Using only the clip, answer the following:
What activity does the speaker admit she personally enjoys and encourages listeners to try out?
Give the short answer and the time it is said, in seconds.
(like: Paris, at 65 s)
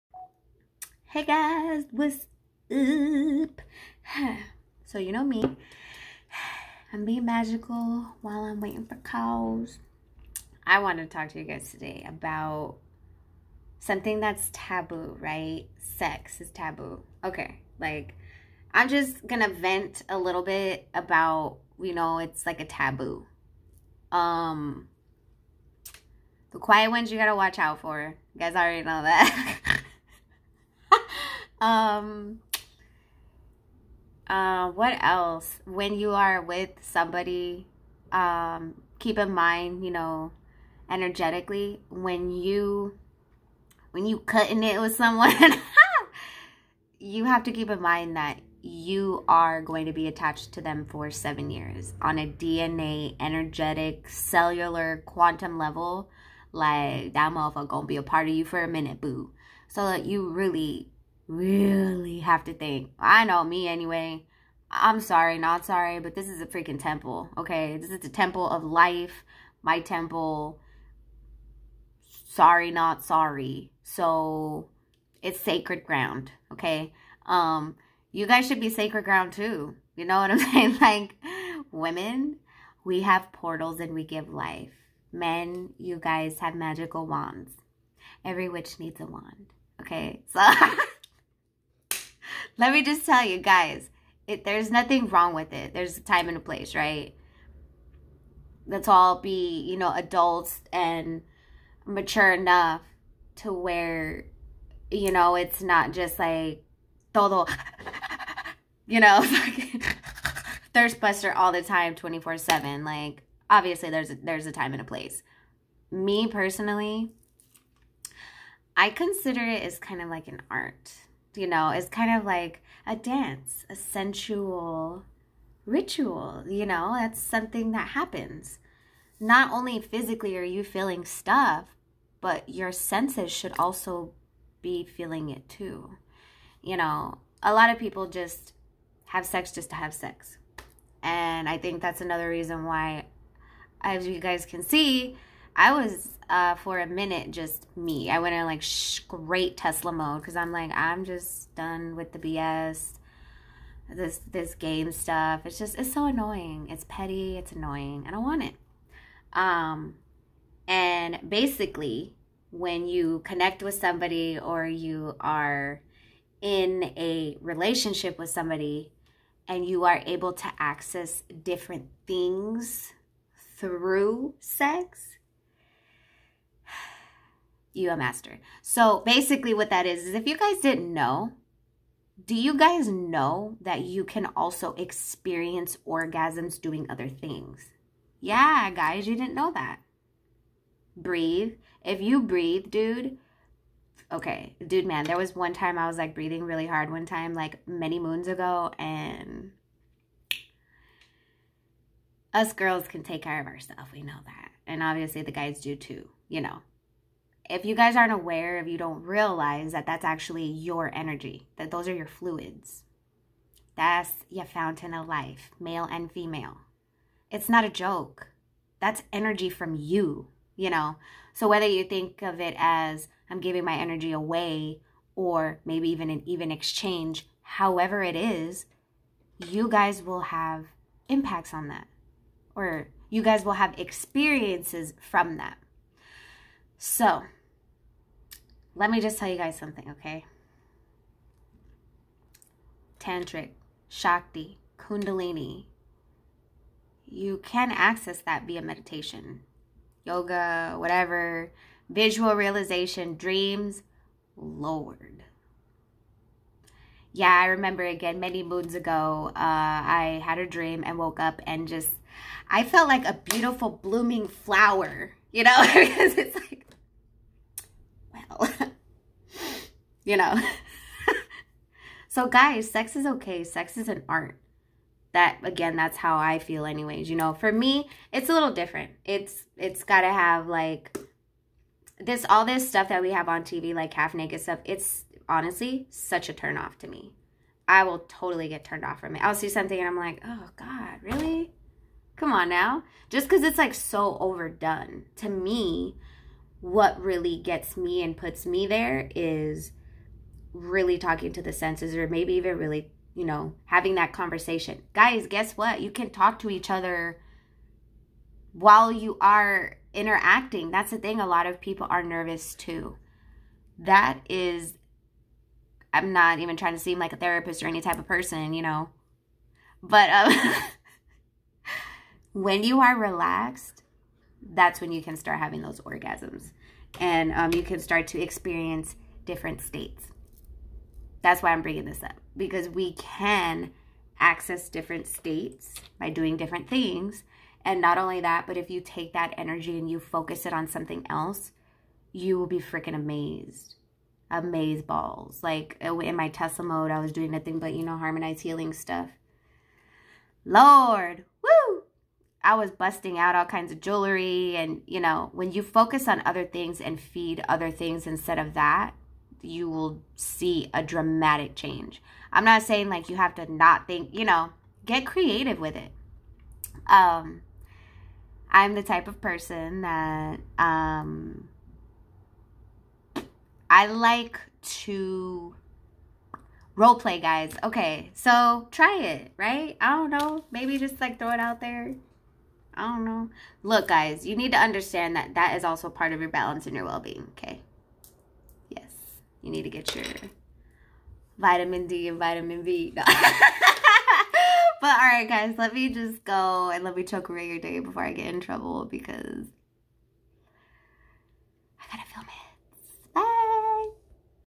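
role play, at 376 s.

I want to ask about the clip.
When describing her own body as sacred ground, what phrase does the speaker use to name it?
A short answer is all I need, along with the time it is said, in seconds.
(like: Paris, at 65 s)
temple of life, at 68 s.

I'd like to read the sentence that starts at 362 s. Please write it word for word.
I'm not saying like you have to not think, you know, get creative with it.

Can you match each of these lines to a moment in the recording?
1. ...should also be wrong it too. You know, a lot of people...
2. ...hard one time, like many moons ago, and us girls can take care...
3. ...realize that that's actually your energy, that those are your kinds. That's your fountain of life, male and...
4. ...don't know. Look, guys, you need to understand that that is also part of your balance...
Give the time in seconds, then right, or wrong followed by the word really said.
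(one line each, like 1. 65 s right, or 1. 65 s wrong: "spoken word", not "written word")
1. 133 s wrong: "feeling", not "wrong"
2. 196 s right
3. 209 s wrong: "fluids", not "kinds"
4. 382 s right.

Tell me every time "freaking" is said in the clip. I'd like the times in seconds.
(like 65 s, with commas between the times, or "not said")
66 s, 342 s.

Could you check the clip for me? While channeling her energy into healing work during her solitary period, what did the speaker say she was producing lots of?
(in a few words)
jewelry.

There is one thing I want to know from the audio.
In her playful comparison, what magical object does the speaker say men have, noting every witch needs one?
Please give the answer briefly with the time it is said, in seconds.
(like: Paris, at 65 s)
magical wands, at 86 s.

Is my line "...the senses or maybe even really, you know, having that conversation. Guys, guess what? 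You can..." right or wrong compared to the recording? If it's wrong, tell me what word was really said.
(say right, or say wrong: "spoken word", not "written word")
right.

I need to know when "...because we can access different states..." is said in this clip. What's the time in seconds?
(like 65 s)
332 s.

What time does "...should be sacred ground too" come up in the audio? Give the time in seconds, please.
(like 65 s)
78 s.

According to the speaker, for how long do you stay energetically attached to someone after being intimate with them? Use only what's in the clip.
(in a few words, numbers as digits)
7 years.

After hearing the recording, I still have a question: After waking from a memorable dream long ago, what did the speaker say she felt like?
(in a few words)
a beautiful blooming flower.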